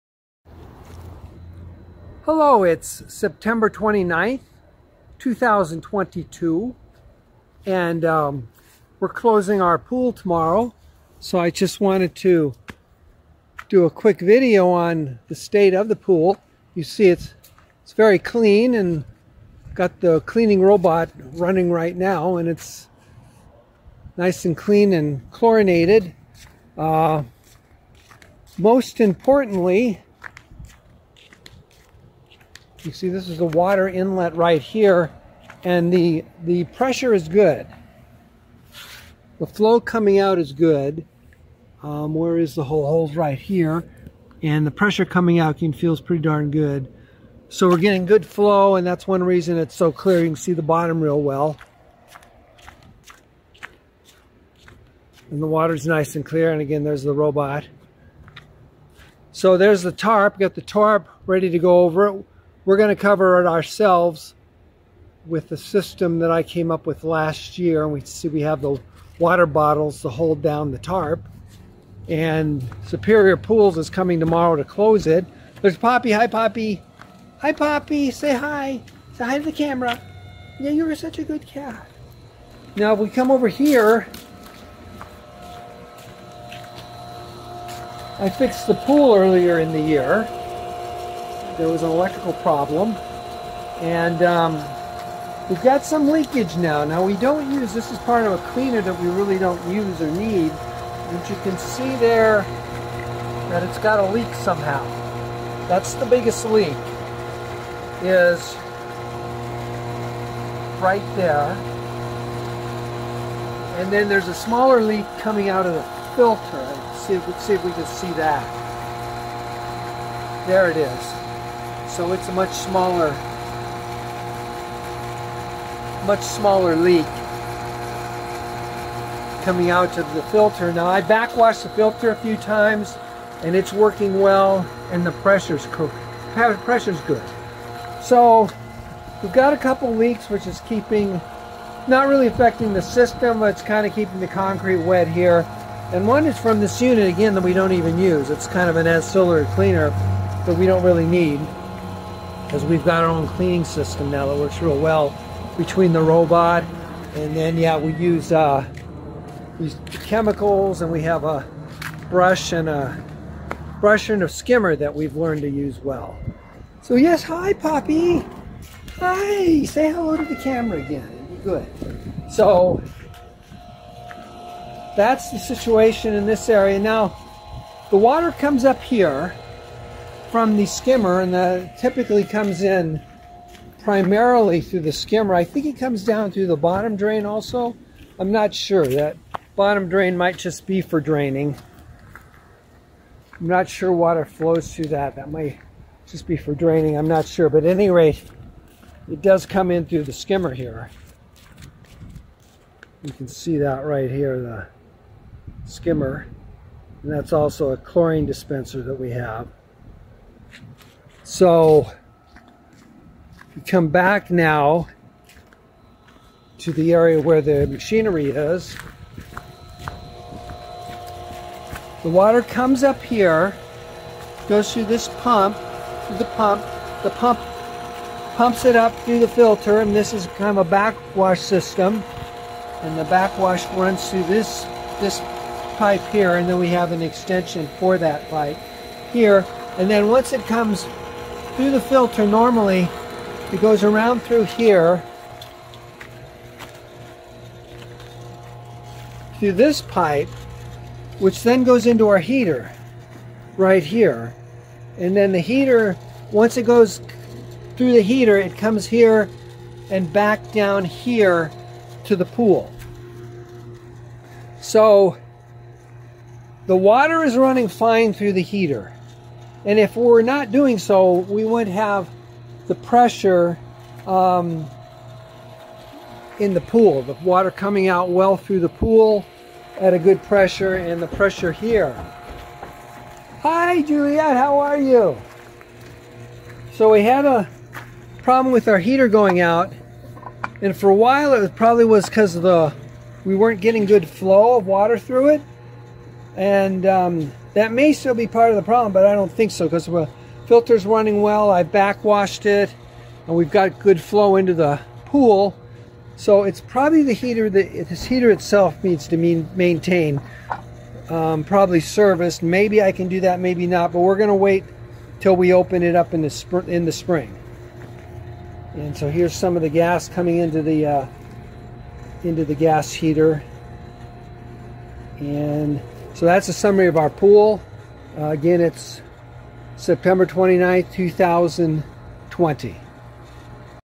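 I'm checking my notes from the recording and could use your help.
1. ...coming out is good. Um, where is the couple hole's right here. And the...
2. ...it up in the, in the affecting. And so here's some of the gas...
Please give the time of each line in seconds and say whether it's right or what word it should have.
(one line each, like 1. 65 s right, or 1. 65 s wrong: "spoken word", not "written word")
1. 39 s wrong: "whole", not "couple"
2. 315 s wrong: "spring", not "affecting".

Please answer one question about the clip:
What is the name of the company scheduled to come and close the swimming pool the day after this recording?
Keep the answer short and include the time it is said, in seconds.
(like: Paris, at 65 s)
Superior Pools, at 72 s.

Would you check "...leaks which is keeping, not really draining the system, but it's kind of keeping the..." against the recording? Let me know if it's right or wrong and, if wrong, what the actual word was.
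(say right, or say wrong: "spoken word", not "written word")
wrong: "affecting", not "draining".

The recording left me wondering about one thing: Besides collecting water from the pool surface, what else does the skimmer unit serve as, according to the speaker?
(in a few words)
chlorine dispenser.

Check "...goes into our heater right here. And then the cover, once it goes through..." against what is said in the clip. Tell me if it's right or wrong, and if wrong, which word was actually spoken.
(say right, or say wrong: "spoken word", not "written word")
wrong: "heater", not "cover".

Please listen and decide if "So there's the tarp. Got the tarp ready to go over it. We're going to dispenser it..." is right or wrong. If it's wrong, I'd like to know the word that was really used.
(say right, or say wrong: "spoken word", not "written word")
wrong: "cover", not "dispenser".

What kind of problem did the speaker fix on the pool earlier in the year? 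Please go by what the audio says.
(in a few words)
electrical problem.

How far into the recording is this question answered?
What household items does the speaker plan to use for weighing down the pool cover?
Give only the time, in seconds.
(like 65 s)
69 s.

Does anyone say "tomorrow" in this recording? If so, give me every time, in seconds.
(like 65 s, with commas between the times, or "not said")
10 s, 74 s.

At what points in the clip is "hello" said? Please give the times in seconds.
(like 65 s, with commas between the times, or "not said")
2 s, 169 s.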